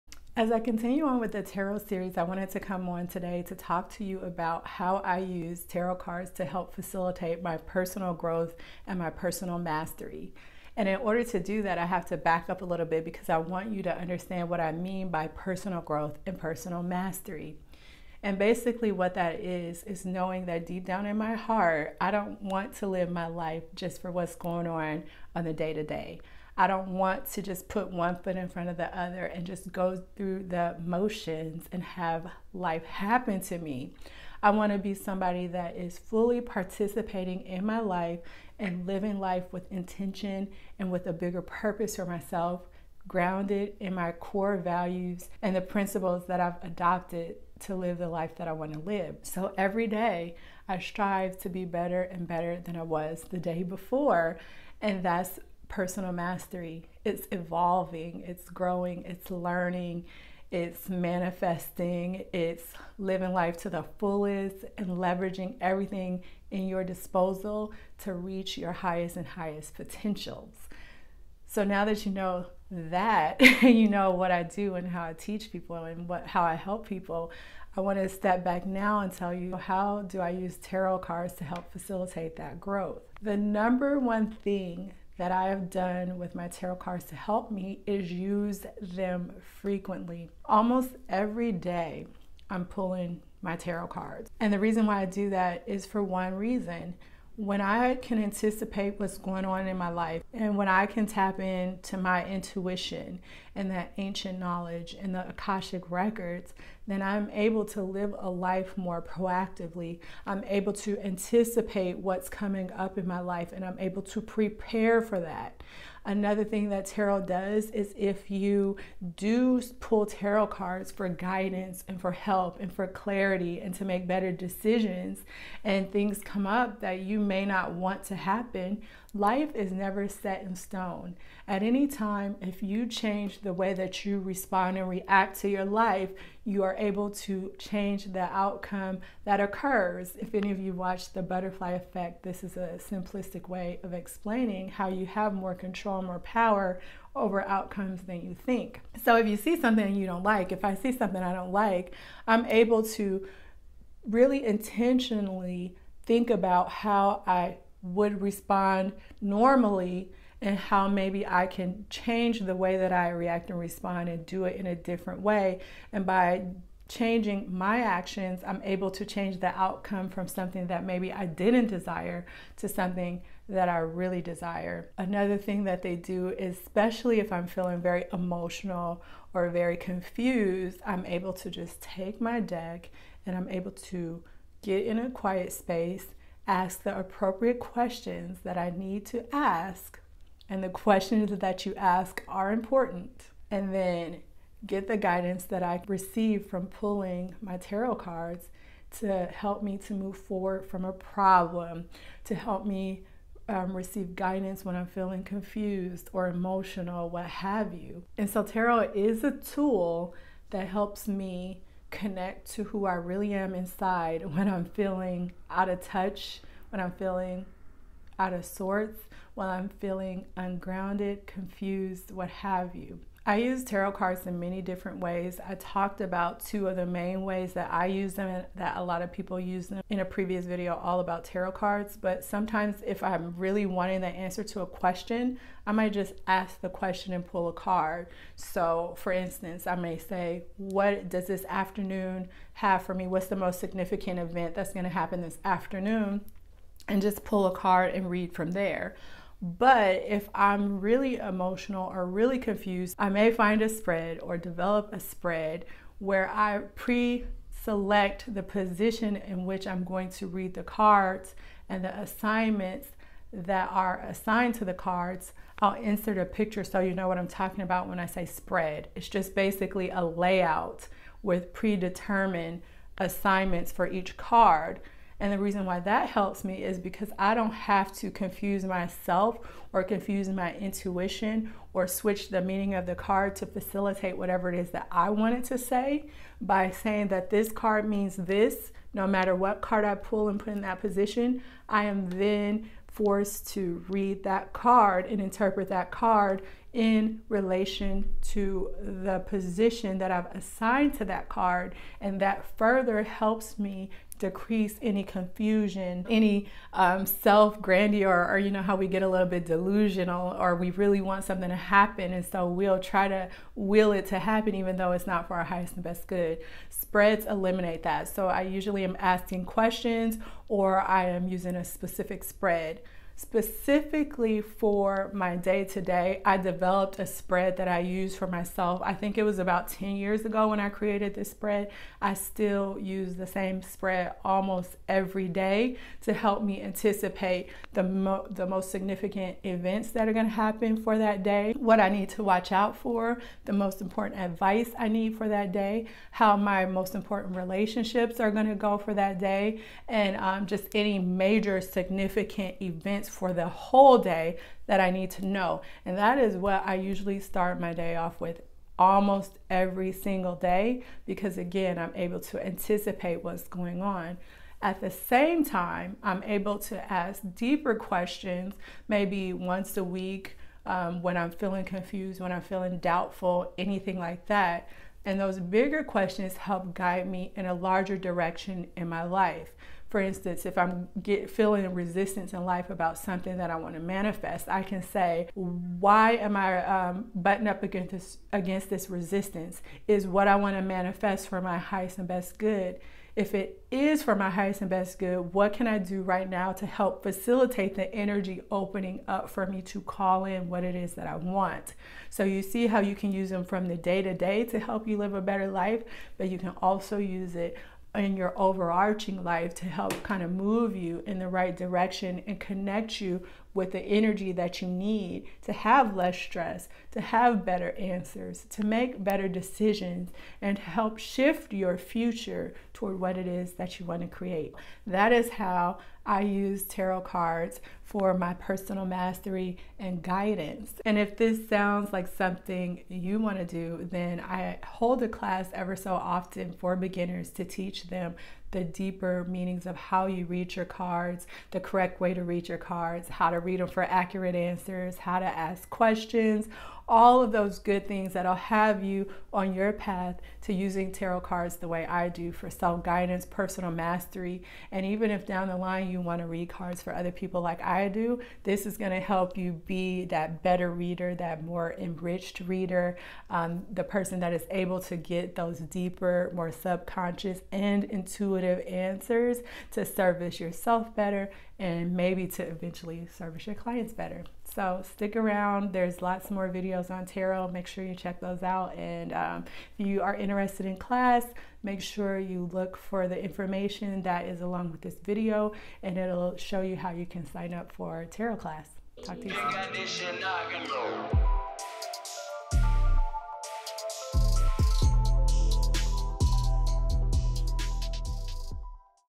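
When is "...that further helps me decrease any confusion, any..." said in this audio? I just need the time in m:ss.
5:02.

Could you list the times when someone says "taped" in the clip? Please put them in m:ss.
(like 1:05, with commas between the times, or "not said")
not said.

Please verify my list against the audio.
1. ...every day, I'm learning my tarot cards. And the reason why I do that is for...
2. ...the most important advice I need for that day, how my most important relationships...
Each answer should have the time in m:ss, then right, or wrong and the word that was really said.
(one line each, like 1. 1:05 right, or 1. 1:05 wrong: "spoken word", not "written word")
1. 1:31 wrong: "pulling", not "learning"
2. 5:43 right.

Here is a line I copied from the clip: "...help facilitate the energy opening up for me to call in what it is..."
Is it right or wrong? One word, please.
right.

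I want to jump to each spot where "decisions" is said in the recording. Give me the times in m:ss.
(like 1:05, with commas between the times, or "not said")
2:04, 6:59.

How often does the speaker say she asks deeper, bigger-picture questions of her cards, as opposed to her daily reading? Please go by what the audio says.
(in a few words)
once a week.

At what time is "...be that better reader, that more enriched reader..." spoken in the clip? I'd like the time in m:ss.
7:39.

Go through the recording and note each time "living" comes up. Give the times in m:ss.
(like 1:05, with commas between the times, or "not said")
0:38, 1:02.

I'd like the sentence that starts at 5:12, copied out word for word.
And so we'll try to will it to happen even though it's not for our highest and best good.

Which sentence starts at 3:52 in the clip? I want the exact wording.
But sometimes if I'm really wanting the answer to a question, I might just ask the question and pull a card.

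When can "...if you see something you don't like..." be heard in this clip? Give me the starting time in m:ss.
2:29.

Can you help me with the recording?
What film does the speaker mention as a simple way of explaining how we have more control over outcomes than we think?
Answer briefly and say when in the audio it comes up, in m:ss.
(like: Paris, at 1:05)
The Butterfly Effect, at 2:21.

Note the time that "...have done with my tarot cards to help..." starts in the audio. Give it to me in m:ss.
1:25.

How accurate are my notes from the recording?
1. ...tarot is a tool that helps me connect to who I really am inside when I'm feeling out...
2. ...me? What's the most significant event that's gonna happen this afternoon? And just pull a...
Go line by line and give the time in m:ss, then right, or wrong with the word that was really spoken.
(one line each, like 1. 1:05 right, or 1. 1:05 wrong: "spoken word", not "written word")
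1. 3:28 right
2. 4:02 right.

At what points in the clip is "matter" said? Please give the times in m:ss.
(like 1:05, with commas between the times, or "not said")
4:49.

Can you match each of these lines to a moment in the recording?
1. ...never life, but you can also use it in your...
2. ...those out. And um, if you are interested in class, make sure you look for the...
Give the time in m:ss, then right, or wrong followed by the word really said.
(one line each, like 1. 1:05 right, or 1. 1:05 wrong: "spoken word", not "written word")
1. 6:45 wrong: "better", not "never"
2. 7:58 right.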